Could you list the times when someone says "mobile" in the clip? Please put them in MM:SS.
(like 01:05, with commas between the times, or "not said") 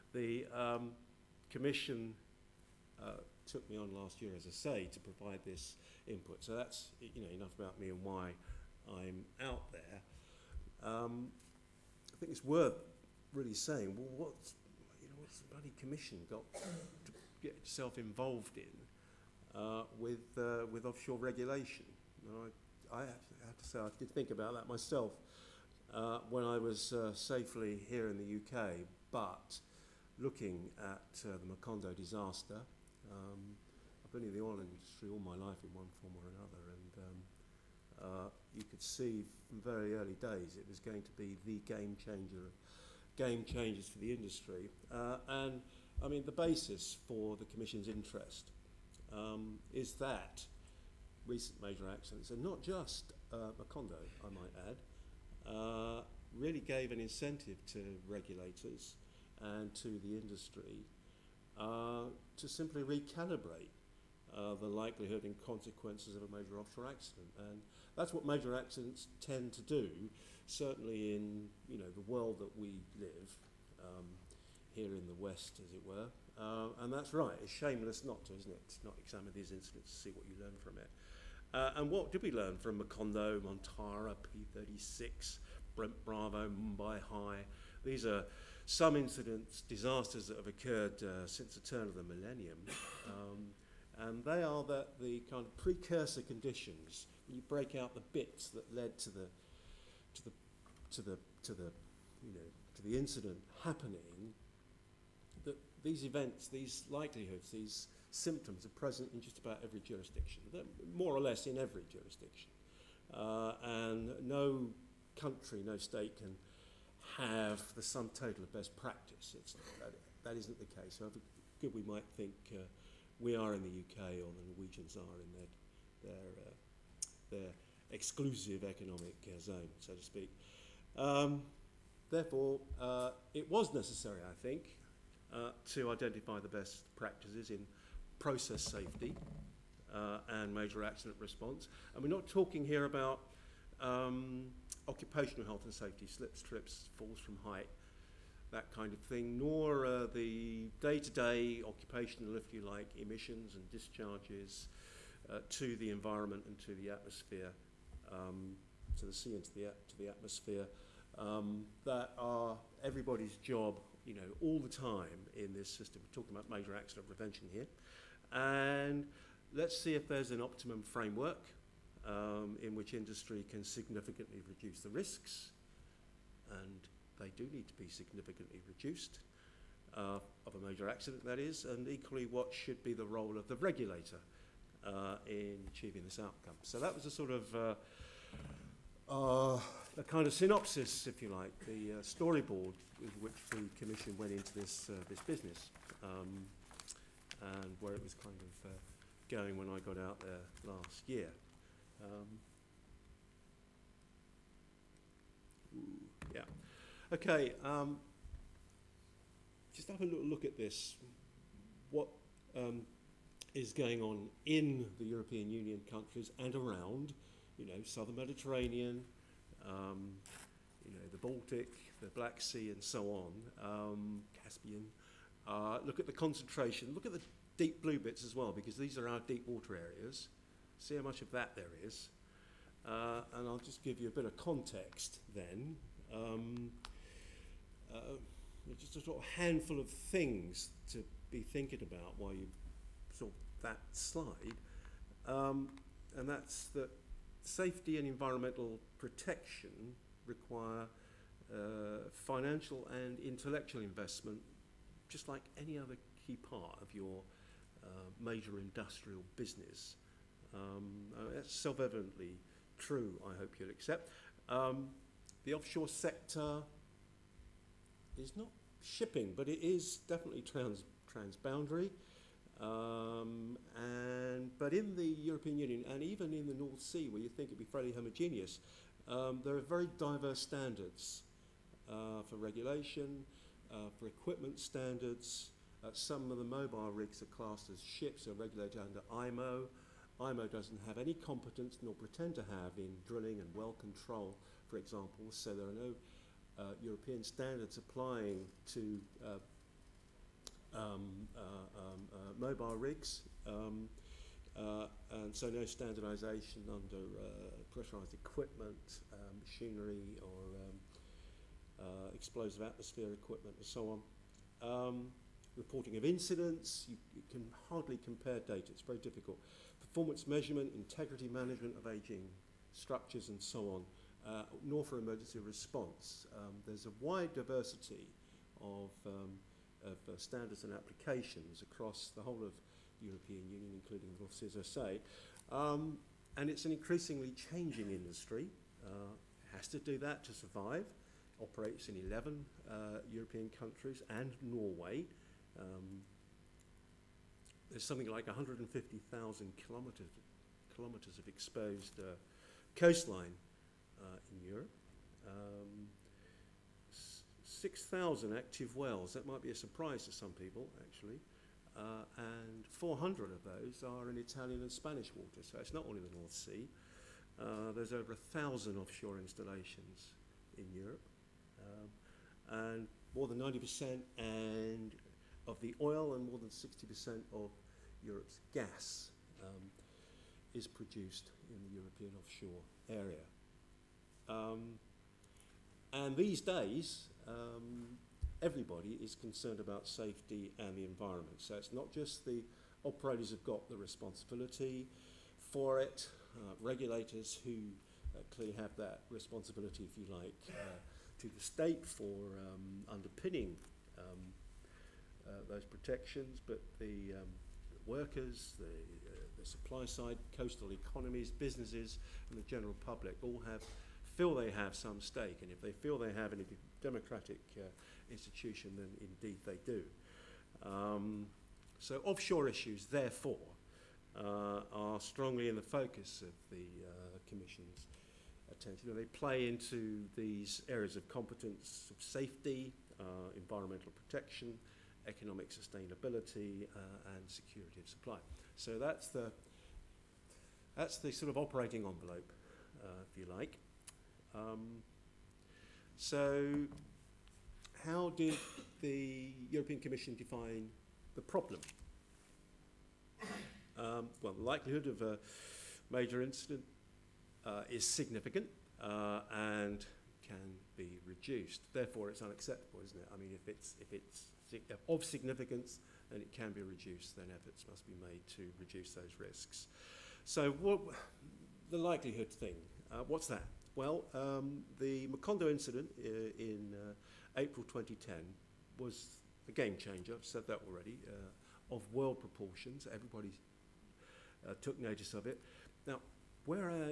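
04:46, 05:02.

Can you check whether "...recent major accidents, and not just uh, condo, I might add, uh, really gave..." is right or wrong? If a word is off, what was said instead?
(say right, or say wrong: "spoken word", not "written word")
right.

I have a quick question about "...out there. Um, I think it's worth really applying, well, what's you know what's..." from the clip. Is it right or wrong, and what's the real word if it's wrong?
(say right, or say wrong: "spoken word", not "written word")
wrong: "saying", not "applying".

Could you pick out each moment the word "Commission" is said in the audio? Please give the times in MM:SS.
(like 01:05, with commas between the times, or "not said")
00:01, 00:15, 00:47, 03:13, 07:07, 07:29.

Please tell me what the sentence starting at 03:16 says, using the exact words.
Um, and where it was kind of uh, going when I got out there last year.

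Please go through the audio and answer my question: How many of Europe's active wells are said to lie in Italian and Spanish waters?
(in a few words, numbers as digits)
400.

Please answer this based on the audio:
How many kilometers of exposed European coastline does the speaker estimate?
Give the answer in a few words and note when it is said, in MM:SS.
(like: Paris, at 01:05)
150,000, at 05:48.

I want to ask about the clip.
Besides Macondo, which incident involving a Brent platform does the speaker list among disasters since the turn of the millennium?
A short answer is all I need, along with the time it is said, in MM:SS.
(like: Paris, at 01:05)
Brent Bravo, at 01:25.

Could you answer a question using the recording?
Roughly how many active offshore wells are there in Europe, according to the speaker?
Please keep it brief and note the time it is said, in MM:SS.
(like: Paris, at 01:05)
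6,000, at 05:57.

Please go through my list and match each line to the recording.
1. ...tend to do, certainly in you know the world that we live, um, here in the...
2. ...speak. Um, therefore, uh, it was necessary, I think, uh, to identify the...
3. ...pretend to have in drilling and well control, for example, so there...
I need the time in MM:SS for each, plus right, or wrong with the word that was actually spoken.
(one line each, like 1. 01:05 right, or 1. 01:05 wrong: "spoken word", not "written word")
1. 01:09 right
2. 02:10 right
3. 04:51 right.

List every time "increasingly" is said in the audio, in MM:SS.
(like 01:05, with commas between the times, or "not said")
05:36.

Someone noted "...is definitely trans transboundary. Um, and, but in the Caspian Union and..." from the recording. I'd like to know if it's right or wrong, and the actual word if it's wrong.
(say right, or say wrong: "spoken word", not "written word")
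wrong: "European", not "Caspian".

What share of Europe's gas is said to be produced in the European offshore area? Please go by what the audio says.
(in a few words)
more than 60%.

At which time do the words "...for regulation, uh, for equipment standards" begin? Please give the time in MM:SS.
04:42.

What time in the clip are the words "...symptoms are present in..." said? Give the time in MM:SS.
01:48.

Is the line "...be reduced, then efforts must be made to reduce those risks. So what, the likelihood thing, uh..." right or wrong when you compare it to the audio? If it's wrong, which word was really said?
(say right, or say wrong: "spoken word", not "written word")
right.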